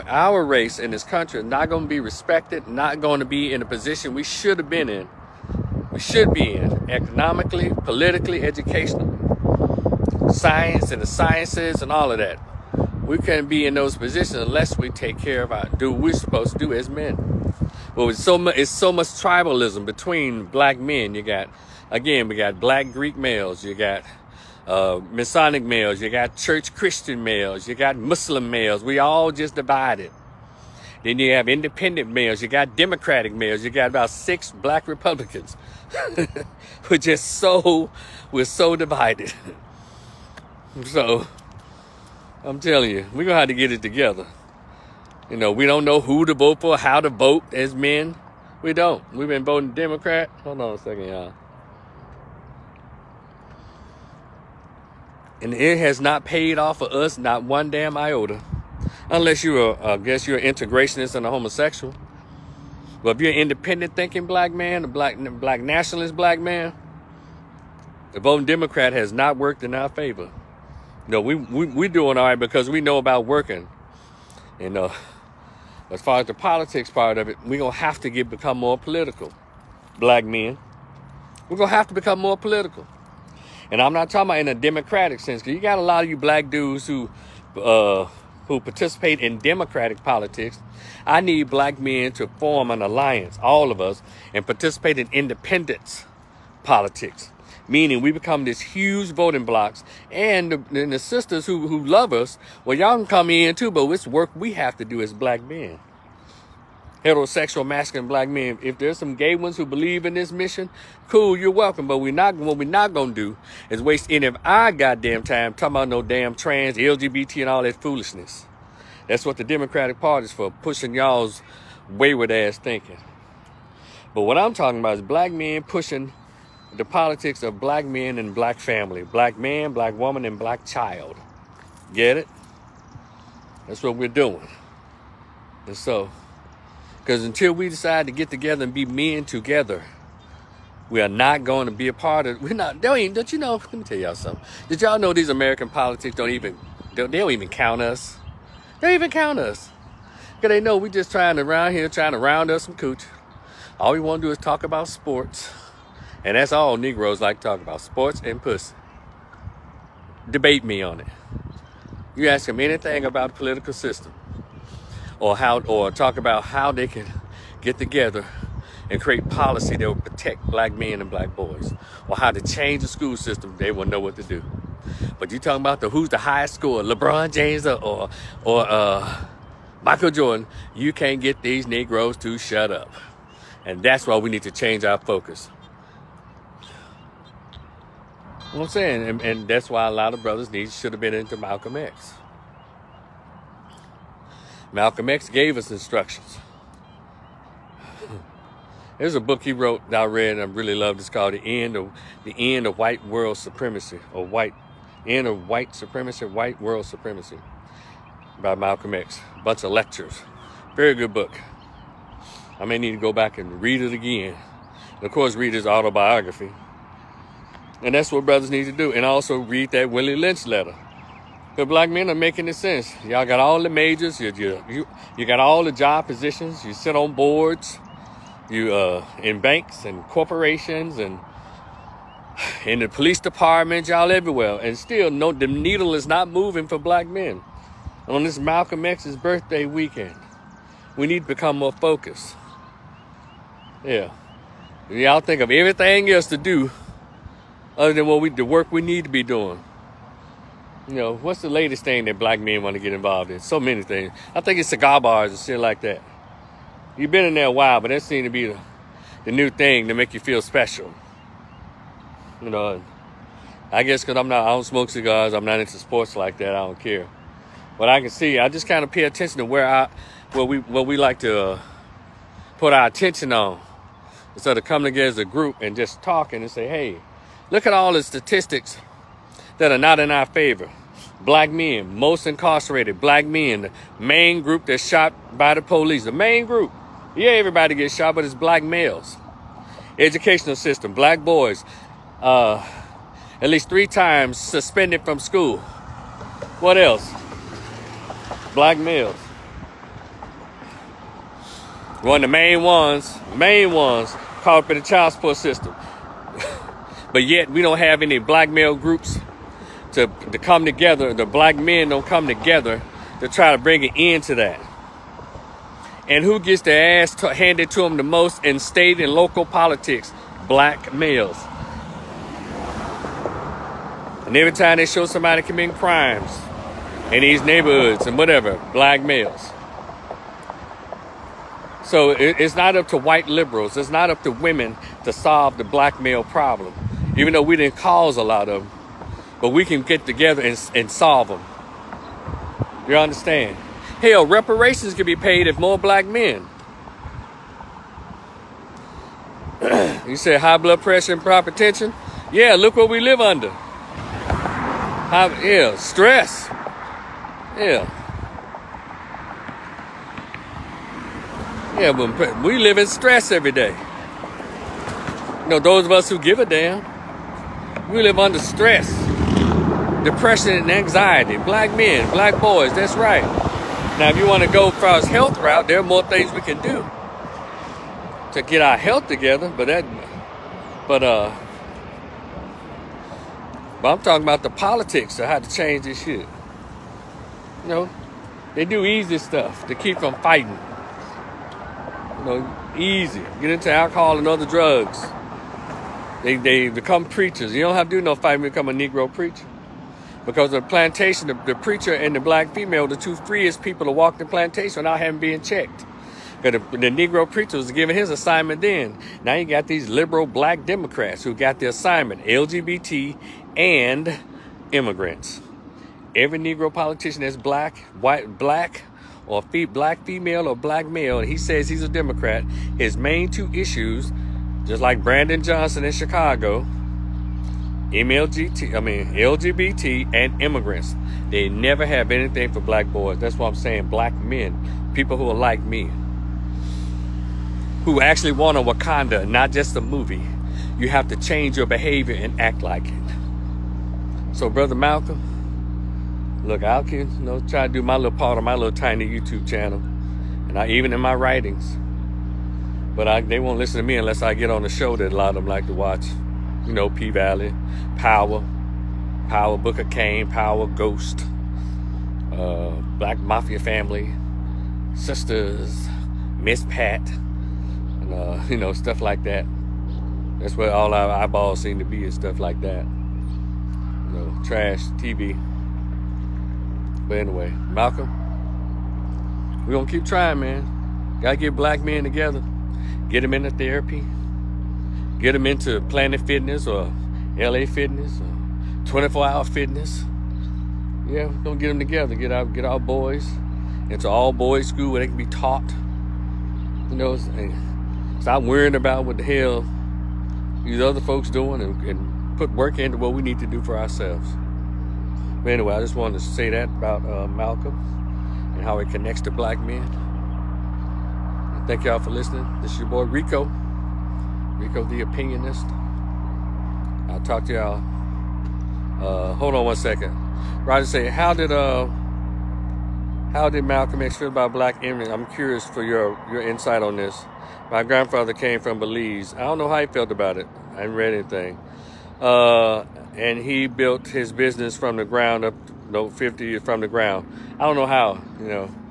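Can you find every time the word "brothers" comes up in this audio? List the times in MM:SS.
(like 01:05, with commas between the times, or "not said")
03:10, 03:38, 07:24.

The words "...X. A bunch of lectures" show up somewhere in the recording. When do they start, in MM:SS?
03:28.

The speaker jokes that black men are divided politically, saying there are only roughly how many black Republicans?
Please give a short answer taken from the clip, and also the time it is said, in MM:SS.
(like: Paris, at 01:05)
6, at 00:34.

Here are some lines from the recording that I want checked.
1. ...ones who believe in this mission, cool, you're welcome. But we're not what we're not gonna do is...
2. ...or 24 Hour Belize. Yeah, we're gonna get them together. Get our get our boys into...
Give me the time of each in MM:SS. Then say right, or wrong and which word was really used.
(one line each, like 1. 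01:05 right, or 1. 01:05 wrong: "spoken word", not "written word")
1. 01:49 right
2. 08:08 wrong: "Fitness", not "Belize".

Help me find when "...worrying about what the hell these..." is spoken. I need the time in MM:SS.
08:18.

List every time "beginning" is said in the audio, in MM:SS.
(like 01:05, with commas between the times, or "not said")
not said.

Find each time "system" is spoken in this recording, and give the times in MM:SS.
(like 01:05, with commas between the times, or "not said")
02:43, 02:53, 04:50, 05:05.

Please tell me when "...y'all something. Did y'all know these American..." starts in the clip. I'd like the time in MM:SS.
02:23.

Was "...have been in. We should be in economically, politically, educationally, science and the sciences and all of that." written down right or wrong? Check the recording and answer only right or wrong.
right.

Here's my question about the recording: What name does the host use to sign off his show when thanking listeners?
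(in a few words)
Rico the Opinionist.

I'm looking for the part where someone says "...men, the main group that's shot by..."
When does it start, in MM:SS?
04:43.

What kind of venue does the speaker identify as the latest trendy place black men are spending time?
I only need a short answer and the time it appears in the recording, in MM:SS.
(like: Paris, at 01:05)
Cigar bars, at 04:14.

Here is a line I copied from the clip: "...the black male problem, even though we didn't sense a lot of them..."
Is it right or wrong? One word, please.
wrong.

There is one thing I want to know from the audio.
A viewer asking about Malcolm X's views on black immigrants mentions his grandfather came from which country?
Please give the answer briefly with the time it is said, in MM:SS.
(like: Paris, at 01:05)
Belize, at 08:48.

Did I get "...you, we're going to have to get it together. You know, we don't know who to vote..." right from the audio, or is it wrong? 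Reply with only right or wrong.
right.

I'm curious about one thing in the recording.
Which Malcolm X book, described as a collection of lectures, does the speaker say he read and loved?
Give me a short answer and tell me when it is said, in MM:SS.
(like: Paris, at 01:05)
The End of White World Supremacy, at 03:22.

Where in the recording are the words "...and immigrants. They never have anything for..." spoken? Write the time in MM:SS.
07:10.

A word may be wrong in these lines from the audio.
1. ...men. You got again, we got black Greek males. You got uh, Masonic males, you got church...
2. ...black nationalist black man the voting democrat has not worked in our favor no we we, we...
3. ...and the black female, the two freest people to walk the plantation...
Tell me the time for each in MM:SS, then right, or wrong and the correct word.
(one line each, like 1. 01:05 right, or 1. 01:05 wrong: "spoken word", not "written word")
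1. 00:20 right
2. 01:05 right
3. 06:41 right.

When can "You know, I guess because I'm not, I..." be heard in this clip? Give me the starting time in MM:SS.
04:22.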